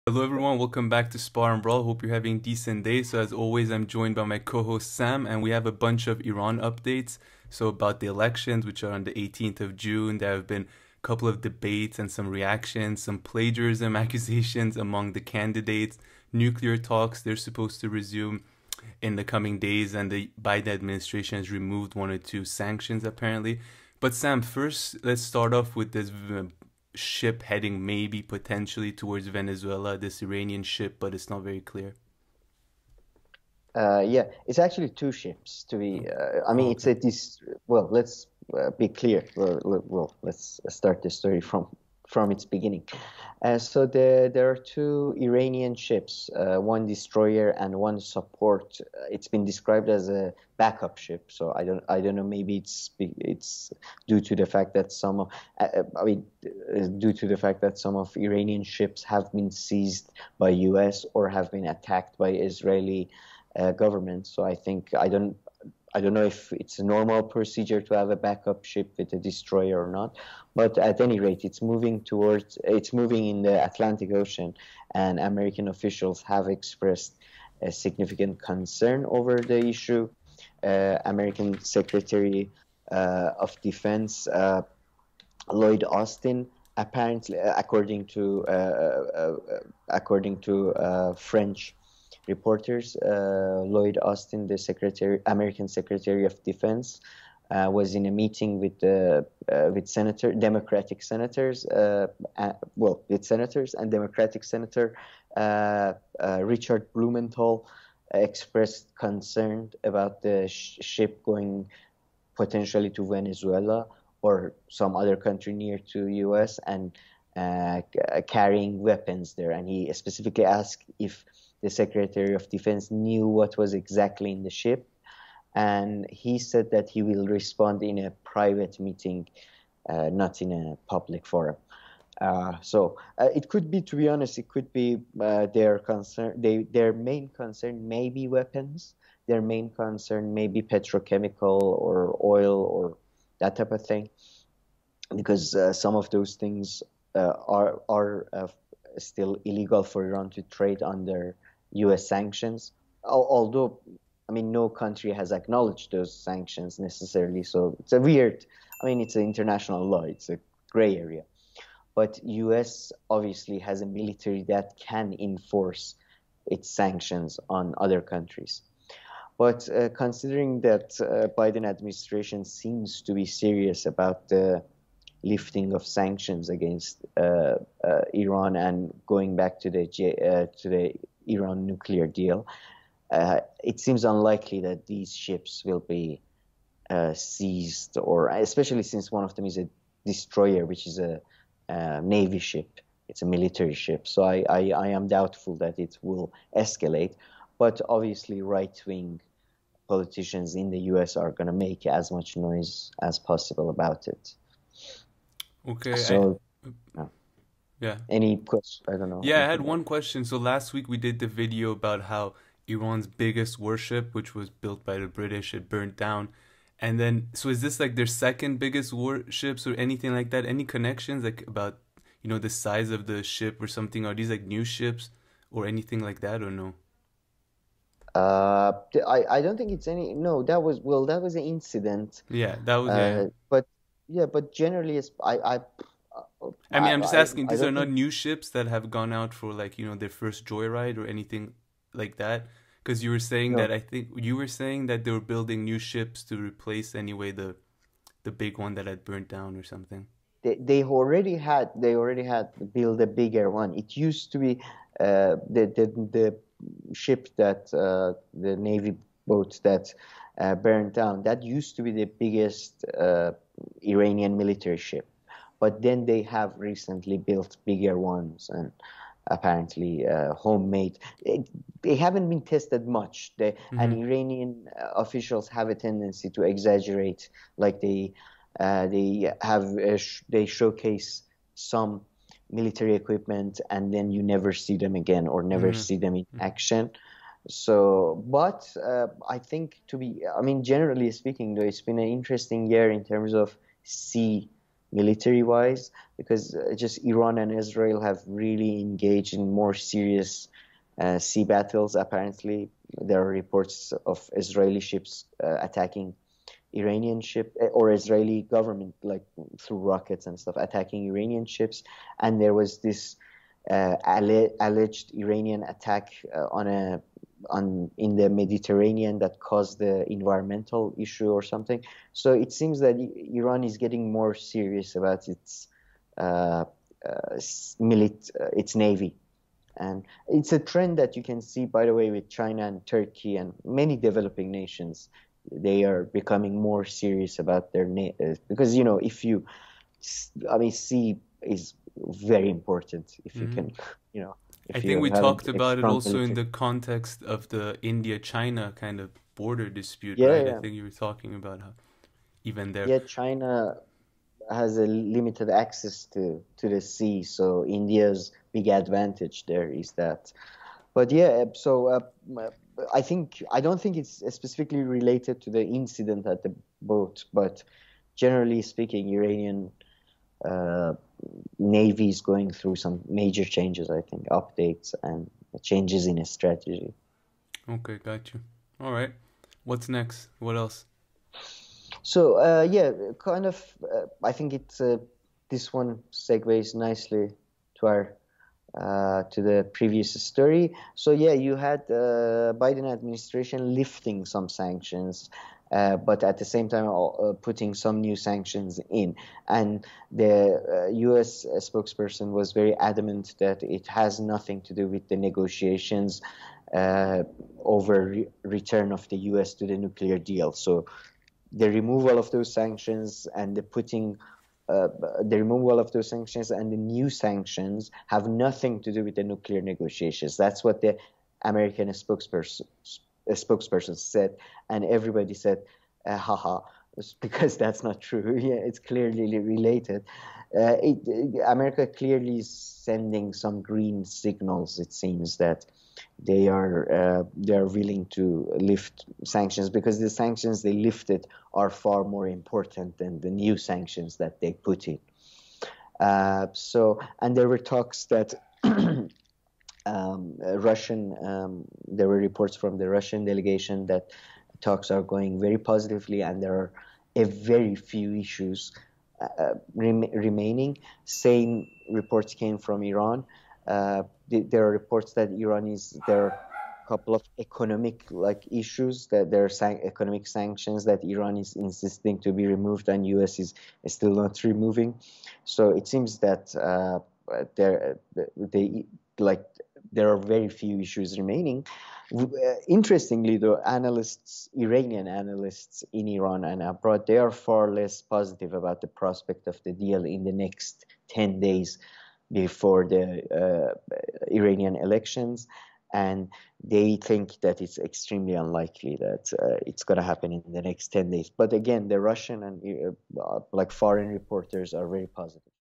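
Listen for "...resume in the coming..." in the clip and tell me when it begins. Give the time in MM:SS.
00:17.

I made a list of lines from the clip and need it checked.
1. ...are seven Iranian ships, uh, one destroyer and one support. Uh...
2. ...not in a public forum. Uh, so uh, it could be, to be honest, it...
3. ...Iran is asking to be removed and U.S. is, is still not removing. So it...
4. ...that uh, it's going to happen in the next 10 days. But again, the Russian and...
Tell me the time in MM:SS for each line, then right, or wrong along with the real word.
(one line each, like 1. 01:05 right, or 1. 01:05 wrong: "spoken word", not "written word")
1. 00:44 wrong: "two", not "seven"
2. 02:10 right
3. 07:51 wrong: "insisting", not "asking"
4. 08:19 right.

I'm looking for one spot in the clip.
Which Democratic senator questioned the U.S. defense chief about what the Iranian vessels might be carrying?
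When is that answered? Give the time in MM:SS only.
01:46.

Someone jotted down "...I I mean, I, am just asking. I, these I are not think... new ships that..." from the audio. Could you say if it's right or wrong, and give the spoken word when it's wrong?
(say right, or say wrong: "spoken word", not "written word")
right.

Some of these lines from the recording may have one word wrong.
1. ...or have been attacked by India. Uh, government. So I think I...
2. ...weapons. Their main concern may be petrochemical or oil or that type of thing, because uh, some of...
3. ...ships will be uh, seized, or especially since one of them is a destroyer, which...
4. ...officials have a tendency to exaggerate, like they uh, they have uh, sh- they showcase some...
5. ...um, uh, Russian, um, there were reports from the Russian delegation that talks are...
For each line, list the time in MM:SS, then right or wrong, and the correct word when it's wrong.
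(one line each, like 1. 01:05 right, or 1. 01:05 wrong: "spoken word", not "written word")
1. 01:01 wrong: "Israeli", not "India"
2. 02:18 right
3. 03:05 right
4. 04:34 right
5. 07:29 right.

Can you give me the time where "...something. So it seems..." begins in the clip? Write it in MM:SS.
05:21.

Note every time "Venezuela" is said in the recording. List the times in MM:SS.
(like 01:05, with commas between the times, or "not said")
00:29, 01:53.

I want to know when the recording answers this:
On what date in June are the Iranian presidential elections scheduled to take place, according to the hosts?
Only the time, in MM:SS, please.
00:09.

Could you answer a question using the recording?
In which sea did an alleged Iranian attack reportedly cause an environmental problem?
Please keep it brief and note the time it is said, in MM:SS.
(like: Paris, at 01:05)
Mediterranean, at 05:18.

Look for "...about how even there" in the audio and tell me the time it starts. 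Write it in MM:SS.
05:51.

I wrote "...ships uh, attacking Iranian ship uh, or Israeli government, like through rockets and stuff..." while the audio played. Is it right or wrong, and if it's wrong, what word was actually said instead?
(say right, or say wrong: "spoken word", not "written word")
right.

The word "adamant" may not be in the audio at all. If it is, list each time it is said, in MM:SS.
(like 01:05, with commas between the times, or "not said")
06:42.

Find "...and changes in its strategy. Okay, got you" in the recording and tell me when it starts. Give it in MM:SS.
06:15.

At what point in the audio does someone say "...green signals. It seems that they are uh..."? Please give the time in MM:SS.
07:13.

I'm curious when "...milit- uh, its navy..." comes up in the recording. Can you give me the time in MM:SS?
05:27.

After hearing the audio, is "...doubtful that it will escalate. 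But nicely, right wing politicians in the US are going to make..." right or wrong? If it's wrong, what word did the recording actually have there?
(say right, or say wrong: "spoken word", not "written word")
wrong: "obviously", not "nicely".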